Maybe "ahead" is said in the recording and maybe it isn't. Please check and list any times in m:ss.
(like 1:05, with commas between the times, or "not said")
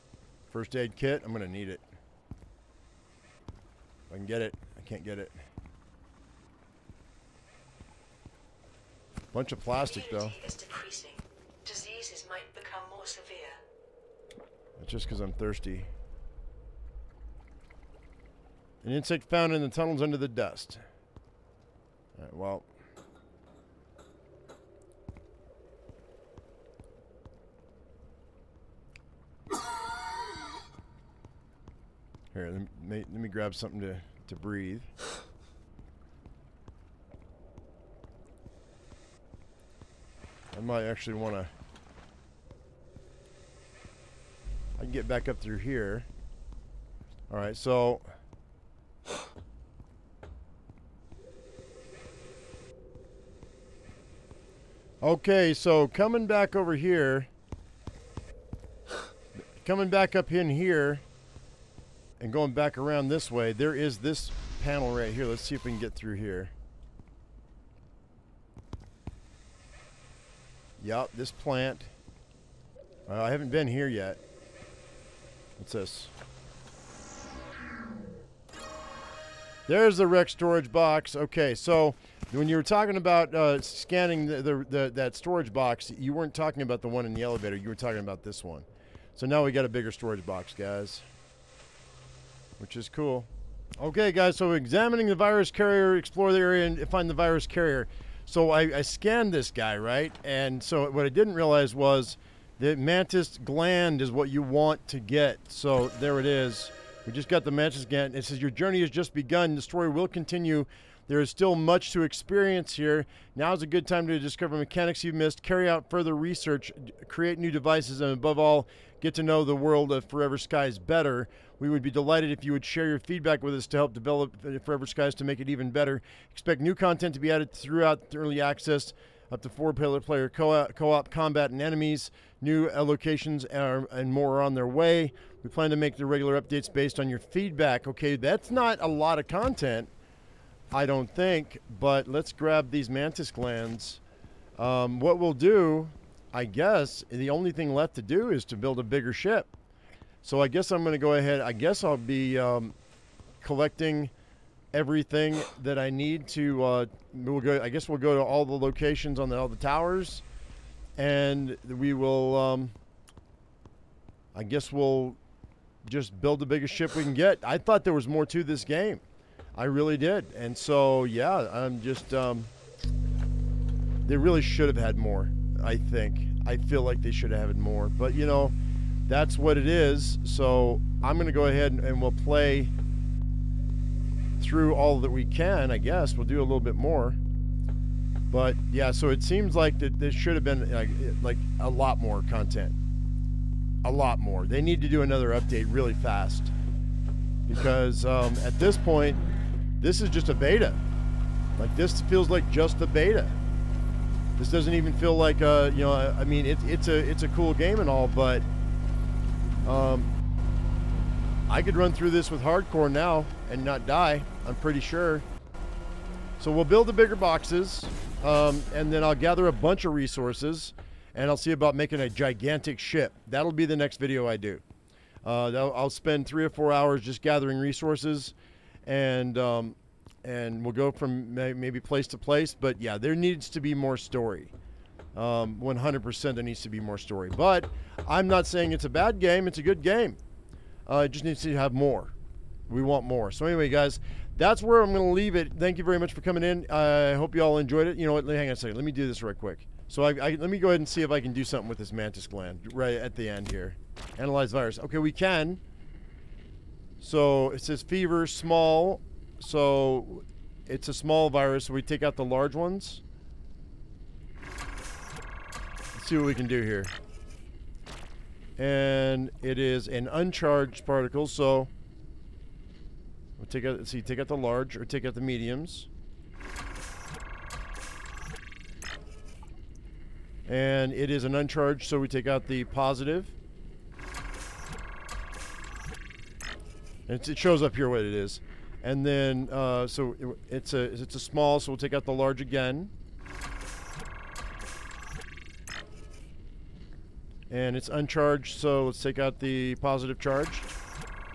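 2:31, 3:01, 4:10.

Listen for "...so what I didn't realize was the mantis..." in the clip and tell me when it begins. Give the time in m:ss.
1:40.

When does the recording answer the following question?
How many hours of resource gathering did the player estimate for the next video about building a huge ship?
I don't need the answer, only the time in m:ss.
3:46.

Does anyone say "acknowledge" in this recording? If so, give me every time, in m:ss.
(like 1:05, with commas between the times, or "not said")
not said.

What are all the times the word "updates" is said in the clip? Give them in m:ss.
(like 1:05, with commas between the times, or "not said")
2:16, 3:15.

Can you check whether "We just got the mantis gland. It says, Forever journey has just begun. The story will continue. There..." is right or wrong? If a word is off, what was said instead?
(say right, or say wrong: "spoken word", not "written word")
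wrong: "Your", not "Forever".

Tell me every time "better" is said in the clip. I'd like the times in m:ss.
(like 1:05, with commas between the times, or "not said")
2:00, 2:05.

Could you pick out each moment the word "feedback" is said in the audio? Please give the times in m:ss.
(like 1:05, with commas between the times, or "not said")
2:02, 2:17.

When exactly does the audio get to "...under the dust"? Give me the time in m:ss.
0:20.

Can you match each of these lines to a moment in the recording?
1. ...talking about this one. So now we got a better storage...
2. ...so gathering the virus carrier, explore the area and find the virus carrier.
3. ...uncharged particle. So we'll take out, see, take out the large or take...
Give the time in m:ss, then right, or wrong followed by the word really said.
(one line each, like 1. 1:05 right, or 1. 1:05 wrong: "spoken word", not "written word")
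1. 1:27 wrong: "bigger", not "better"
2. 1:34 wrong: "examining", not "gathering"
3. 4:30 right.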